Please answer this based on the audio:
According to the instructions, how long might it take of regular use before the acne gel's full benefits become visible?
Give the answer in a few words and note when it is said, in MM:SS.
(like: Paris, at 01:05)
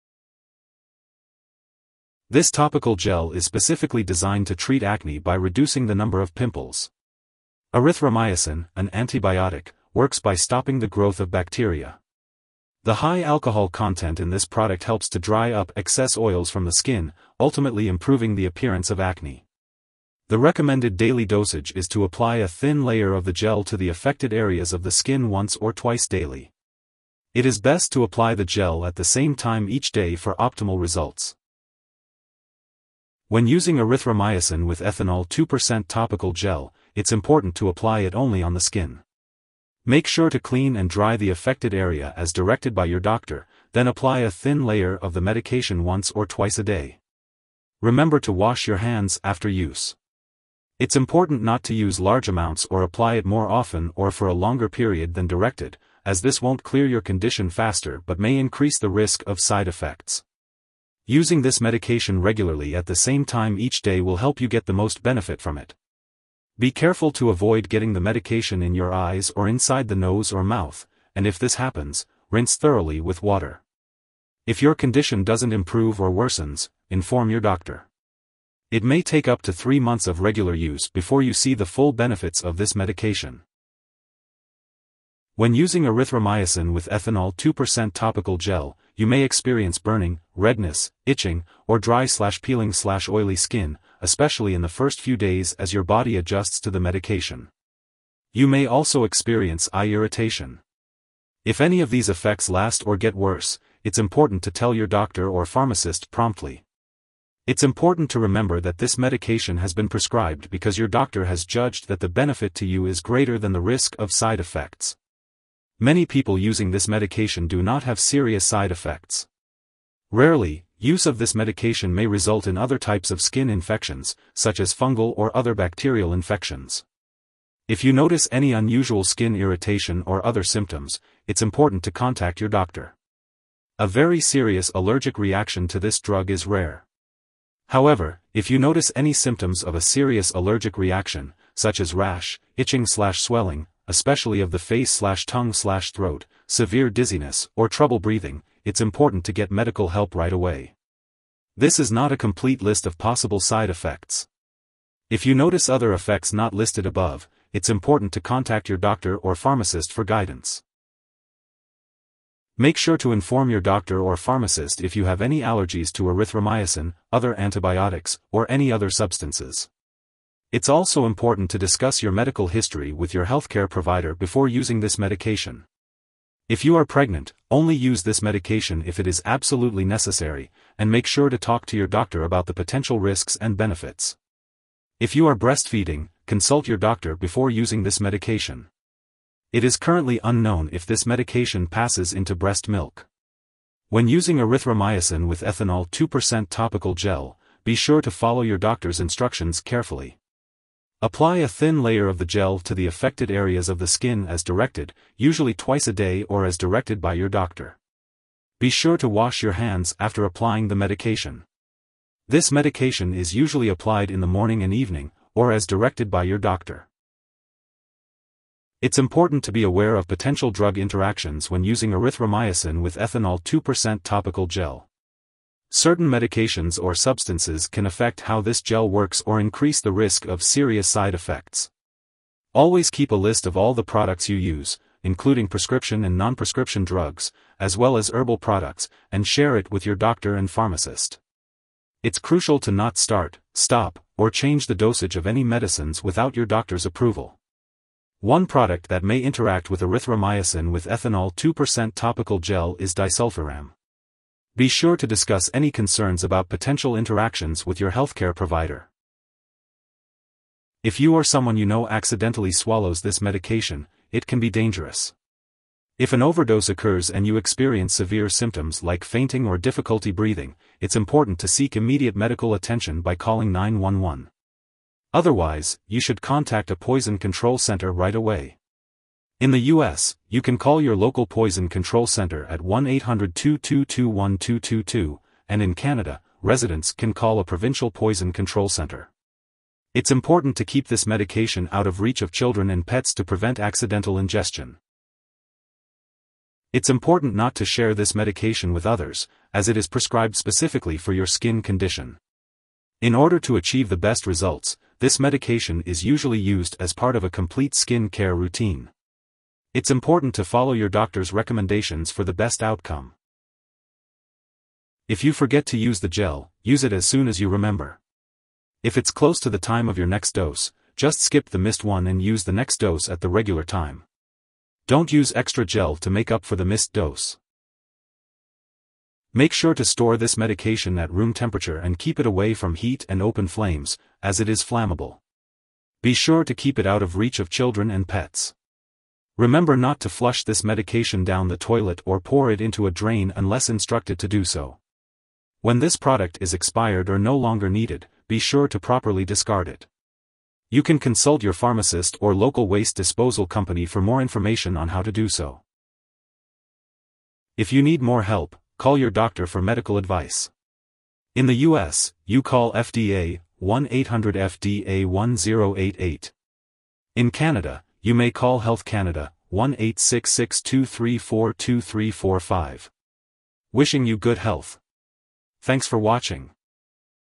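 3 months, at 01:19.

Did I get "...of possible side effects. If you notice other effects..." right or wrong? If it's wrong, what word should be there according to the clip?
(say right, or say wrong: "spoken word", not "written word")
right.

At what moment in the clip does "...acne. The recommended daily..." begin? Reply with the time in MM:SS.
00:19.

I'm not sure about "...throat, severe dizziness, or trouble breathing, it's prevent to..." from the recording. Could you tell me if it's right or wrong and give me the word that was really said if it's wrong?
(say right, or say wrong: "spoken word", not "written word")
wrong: "important", not "prevent".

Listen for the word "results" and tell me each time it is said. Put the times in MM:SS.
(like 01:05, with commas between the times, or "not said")
00:30, 02:02, 05:04.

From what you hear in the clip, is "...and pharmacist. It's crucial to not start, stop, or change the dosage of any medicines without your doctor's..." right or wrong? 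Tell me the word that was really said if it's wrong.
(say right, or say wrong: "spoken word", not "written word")
right.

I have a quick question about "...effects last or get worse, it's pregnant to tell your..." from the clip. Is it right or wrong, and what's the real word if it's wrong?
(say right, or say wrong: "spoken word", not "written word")
wrong: "important", not "pregnant".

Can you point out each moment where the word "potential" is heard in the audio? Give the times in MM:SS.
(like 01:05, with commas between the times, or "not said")
03:02, 03:40, 04:16.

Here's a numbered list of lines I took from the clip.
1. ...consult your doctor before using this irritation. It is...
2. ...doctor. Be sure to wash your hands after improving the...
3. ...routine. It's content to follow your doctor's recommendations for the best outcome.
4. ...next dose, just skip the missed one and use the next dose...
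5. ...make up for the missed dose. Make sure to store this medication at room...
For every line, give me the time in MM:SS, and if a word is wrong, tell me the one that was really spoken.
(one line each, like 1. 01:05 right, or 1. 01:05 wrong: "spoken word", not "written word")
1. 03:06 wrong: "medication", not "irritation"
2. 03:27 wrong: "applying", not "improving"
3. 05:08 wrong: "important", not "content"
4. 05:20 right
5. 05:26 right.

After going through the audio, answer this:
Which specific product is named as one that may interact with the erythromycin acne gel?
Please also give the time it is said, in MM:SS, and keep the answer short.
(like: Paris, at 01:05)
disulfiram, at 04:12.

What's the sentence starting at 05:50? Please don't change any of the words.
You can consult your pharmacist or local waste disposal company for more information on how to do so.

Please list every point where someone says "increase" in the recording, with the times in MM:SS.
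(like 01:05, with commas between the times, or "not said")
00:58, 03:49.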